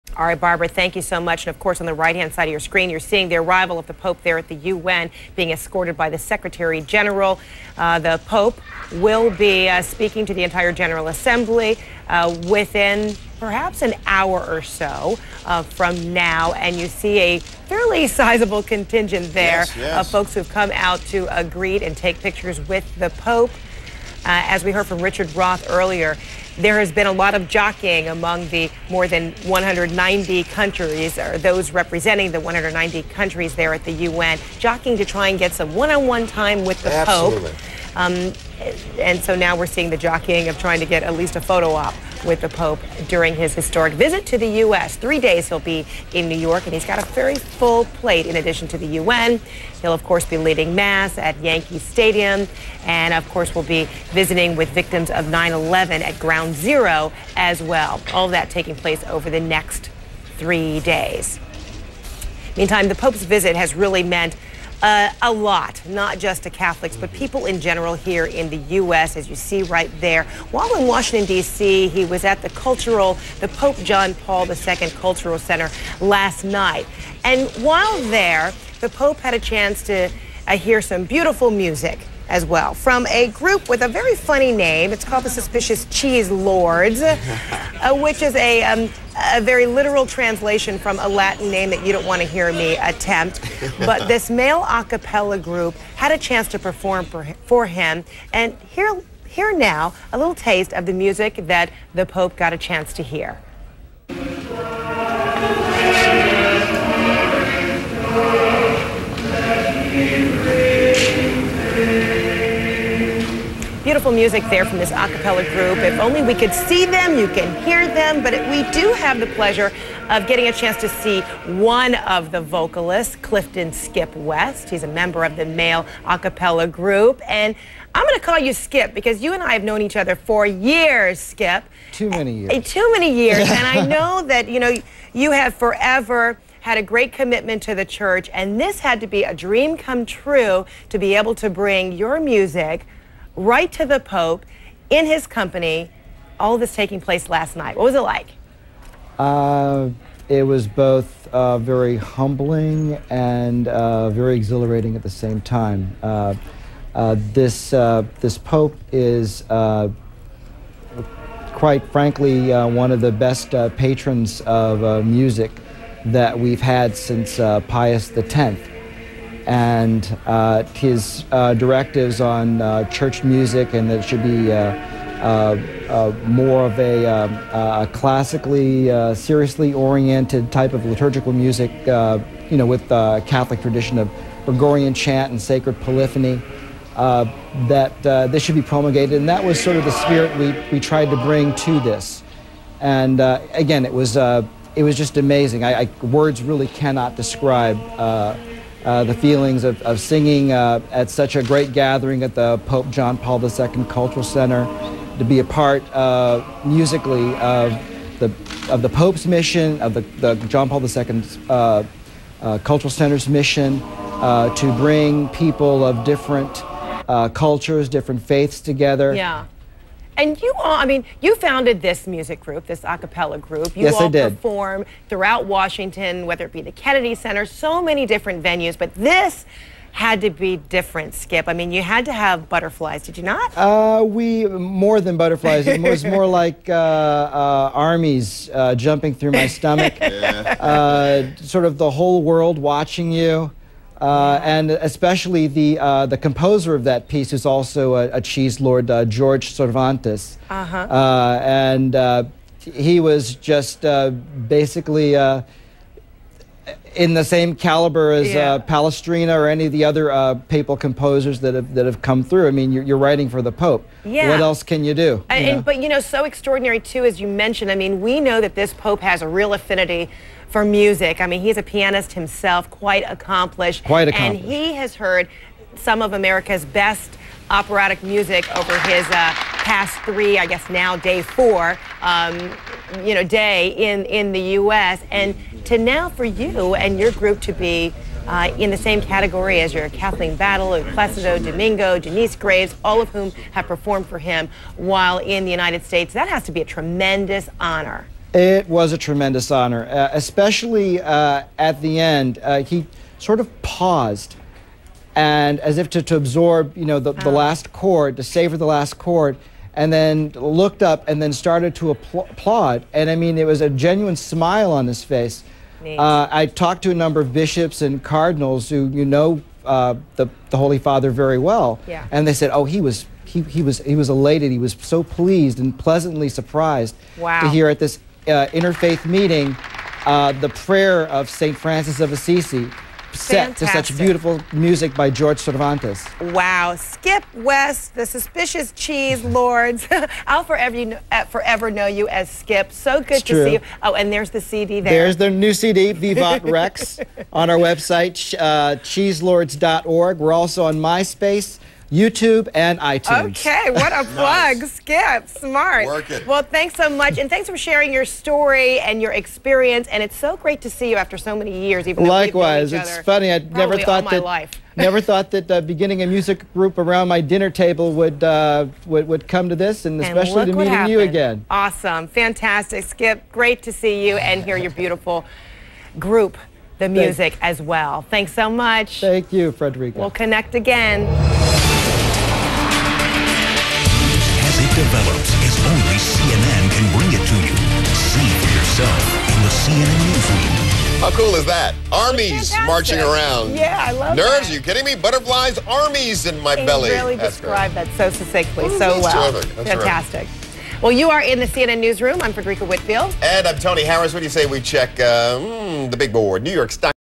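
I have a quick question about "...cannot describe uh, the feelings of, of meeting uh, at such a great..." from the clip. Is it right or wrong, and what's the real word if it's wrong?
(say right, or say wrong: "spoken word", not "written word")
wrong: "singing", not "meeting".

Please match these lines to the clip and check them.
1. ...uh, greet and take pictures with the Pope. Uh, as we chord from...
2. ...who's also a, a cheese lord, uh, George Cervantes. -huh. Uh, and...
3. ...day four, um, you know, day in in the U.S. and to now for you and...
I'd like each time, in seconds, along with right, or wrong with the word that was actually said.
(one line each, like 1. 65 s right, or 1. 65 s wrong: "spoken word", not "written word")
1. 21 s wrong: "heard", not "chord"
2. 247 s right
3. 280 s right.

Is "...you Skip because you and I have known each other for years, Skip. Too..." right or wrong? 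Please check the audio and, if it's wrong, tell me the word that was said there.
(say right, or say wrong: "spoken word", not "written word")
right.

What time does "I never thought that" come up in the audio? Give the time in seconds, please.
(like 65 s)
363 s.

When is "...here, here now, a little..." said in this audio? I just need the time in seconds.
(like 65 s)
98 s.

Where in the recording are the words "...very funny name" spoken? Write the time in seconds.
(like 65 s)
83 s.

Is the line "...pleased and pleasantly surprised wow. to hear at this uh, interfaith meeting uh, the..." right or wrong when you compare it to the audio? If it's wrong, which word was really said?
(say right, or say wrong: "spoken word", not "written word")
right.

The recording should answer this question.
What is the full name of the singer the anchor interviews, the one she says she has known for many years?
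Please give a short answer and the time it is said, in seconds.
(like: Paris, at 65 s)
Clifton Skip West, at 123 s.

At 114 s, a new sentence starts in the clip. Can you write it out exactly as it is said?
music there from this a cappella group.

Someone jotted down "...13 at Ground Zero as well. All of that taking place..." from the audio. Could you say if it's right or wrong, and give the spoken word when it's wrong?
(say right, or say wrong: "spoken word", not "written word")
wrong: "11", not "13".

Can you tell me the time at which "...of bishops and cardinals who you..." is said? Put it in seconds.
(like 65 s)
317 s.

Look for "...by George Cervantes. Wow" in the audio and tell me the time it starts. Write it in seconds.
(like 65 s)
334 s.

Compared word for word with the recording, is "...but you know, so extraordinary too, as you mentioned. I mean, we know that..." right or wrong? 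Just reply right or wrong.
right.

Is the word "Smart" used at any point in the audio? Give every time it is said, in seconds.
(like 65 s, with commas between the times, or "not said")
355 s.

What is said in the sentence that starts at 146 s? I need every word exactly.
All this taking place last night.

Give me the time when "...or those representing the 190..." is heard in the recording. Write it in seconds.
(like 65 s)
31 s.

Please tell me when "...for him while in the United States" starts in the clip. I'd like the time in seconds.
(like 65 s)
294 s.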